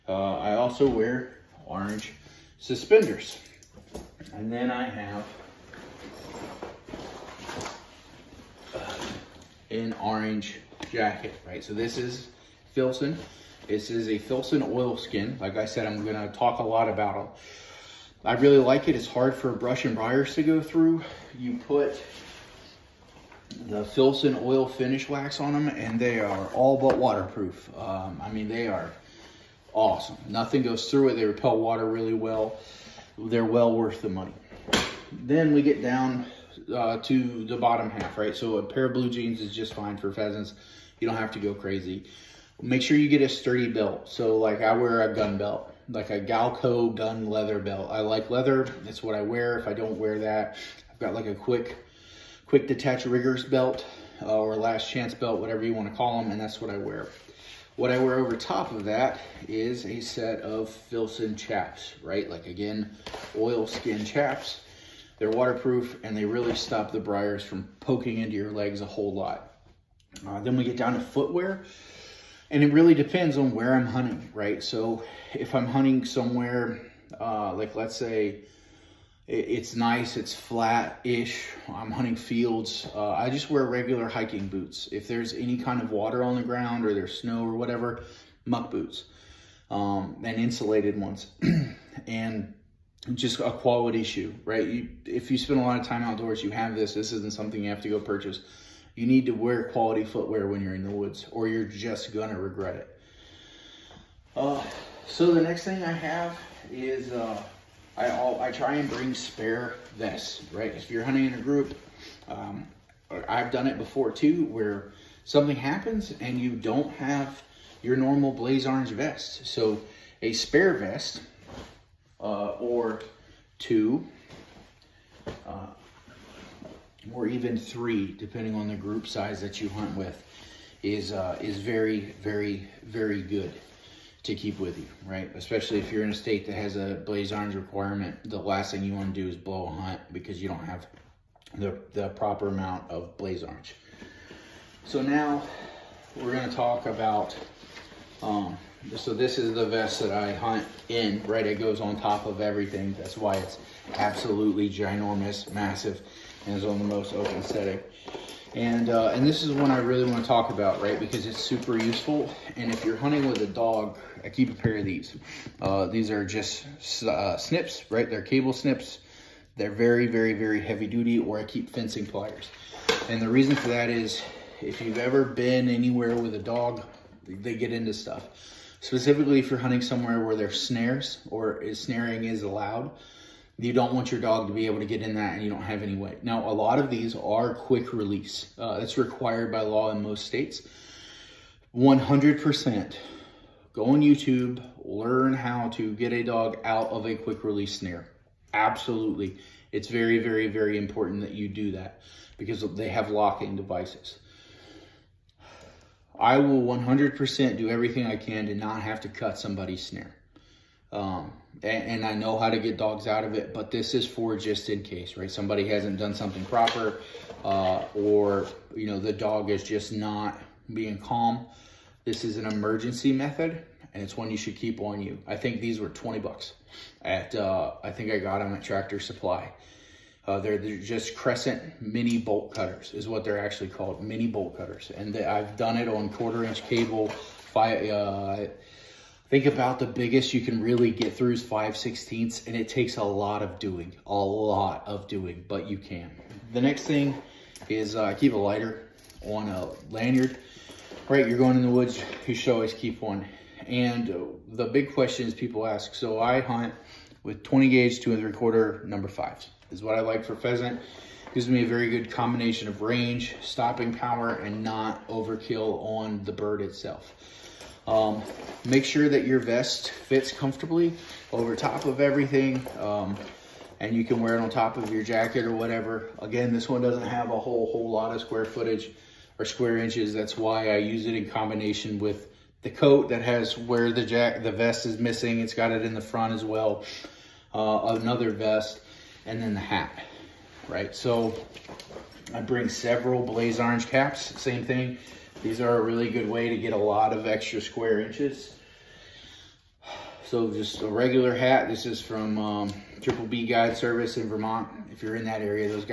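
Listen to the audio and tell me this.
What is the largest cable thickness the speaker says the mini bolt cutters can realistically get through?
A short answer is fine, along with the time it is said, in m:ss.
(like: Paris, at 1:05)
5/16 inch, at 4:01.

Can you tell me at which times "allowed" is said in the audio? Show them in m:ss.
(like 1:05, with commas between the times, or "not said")
3:02.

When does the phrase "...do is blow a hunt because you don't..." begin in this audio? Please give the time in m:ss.
2:19.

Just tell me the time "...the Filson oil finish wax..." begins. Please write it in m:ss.
0:23.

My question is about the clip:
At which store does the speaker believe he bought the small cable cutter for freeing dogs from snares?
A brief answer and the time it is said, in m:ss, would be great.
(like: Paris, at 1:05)
Tractor Supply, at 3:48.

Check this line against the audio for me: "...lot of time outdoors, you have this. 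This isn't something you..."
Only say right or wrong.
right.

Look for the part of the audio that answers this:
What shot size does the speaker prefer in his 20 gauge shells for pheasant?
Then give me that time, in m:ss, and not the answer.
4:18.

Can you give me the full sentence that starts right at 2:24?
So now we're going to talk about, um, so this is the vest that I hunt in, right?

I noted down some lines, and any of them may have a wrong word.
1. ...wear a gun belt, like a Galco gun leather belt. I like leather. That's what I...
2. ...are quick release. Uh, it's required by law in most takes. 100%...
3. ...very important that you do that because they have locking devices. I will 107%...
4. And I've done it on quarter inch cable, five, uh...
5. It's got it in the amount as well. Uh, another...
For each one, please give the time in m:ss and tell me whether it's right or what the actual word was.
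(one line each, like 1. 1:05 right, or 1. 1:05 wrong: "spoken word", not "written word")
1. 0:44 right
2. 3:07 wrong: "states", not "takes"
3. 3:20 wrong: "100", not "107"
4. 3:54 right
5. 4:45 wrong: "front", not "amount".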